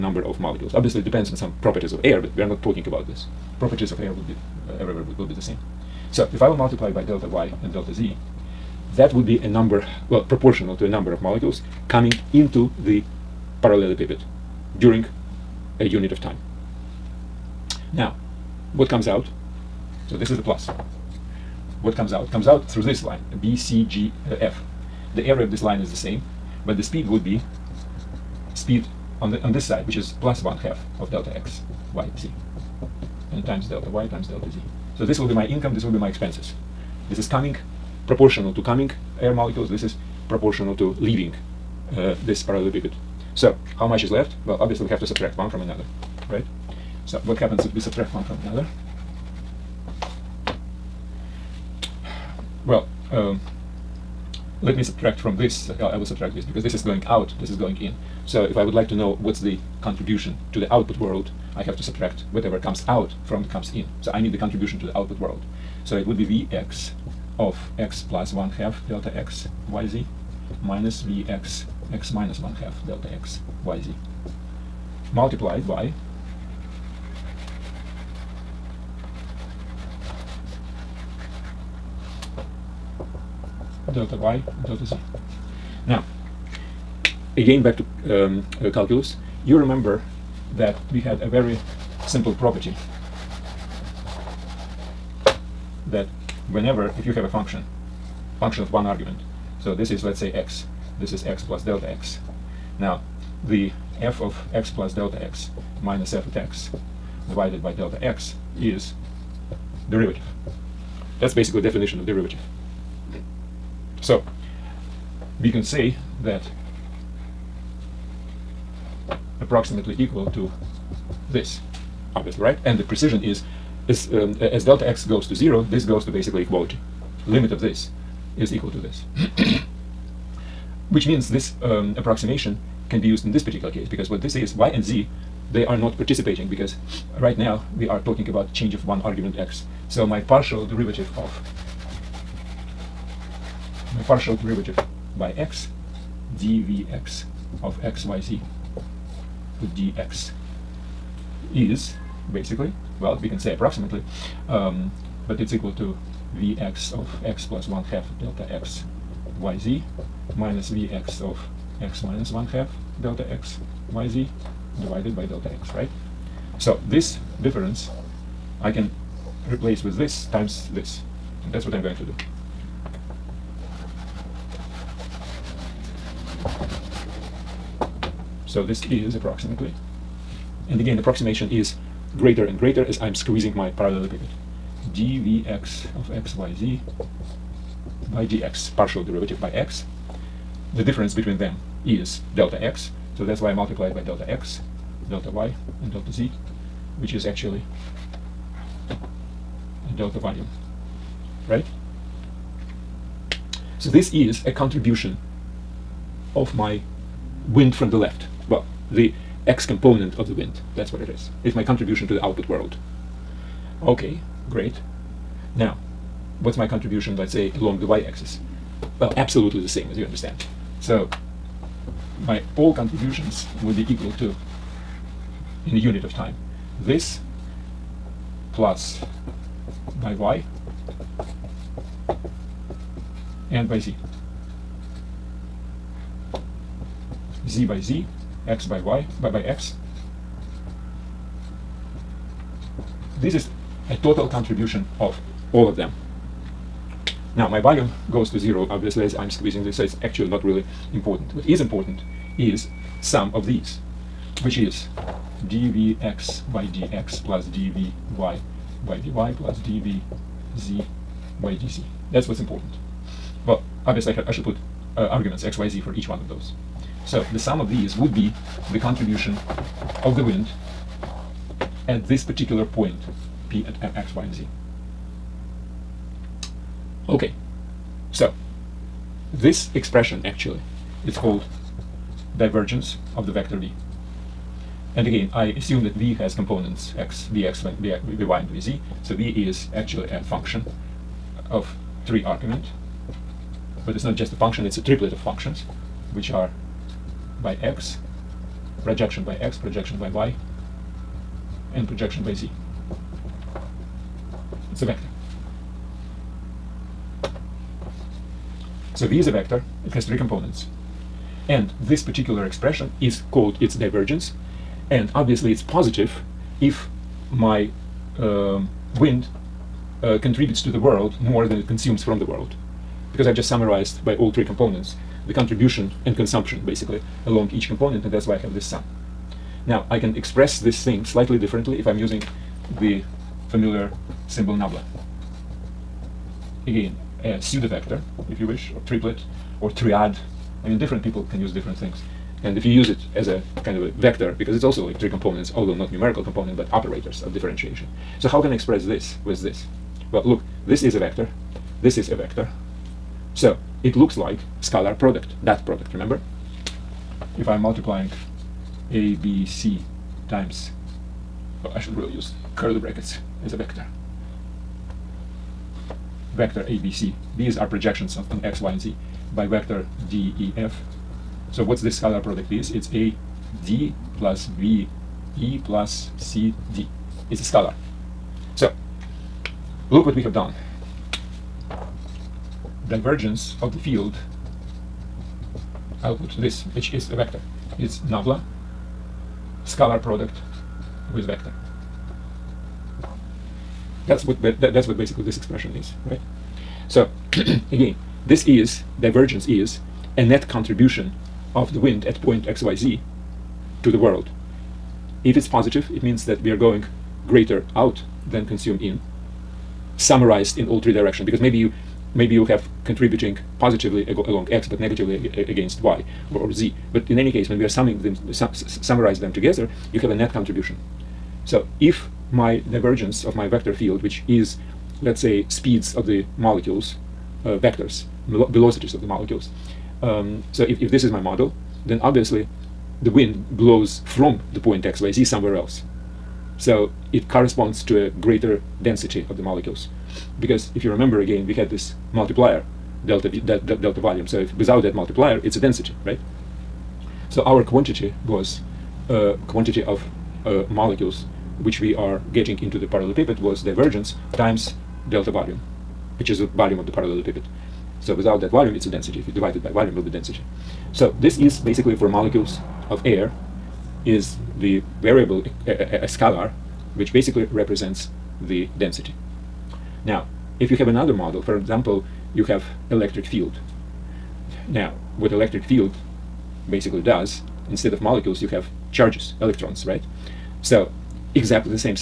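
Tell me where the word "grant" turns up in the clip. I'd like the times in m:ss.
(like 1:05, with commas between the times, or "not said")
not said.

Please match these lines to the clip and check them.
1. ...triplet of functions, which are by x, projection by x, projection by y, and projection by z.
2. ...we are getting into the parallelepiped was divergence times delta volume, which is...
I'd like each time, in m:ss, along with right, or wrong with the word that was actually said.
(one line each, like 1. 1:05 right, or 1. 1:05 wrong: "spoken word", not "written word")
1. 4:54 right
2. 7:31 right.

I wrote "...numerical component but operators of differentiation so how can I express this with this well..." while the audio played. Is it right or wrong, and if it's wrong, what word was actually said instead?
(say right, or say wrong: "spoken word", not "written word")
right.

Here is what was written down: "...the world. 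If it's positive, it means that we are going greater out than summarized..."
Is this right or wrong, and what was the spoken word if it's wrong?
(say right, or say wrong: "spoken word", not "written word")
wrong: "consumed", not "summarized".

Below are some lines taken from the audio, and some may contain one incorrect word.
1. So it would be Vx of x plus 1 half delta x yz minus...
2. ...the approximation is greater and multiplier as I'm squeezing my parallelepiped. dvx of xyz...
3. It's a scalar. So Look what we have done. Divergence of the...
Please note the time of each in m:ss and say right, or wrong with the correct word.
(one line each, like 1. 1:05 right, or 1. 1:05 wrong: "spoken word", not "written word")
1. 1:05 right
2. 3:00 wrong: "greater", not "multiplier"
3. 6:17 right.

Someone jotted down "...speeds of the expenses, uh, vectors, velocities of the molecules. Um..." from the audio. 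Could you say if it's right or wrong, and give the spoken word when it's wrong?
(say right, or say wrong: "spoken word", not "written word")
wrong: "molecules", not "expenses".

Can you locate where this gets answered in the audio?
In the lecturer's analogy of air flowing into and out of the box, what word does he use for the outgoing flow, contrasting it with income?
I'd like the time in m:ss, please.
0:36.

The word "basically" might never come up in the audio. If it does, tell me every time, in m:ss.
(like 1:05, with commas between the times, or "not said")
1:51, 2:06, 2:32, 5:26, 6:34, 7:41, 7:47, 7:56.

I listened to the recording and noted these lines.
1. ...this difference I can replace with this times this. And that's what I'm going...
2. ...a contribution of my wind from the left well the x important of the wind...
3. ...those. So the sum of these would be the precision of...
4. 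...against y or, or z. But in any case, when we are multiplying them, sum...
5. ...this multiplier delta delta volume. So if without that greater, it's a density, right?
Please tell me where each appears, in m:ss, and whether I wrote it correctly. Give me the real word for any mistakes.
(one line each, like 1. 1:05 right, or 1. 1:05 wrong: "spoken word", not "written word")
1. 2:46 right
2. 3:24 wrong: "component", not "important"
3. 4:26 wrong: "contribution", not "precision"
4. 6:55 wrong: "summing", not "multiplying"
5. 7:21 wrong: "multiplier", not "greater".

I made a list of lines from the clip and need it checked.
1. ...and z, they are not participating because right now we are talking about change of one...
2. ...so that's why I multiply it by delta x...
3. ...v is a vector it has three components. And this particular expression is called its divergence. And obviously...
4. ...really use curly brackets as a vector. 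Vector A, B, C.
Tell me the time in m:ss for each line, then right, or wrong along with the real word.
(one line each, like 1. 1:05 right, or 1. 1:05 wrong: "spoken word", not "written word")
1. 2:14 right
2. 3:13 right
3. 5:09 right
4. 6:01 right.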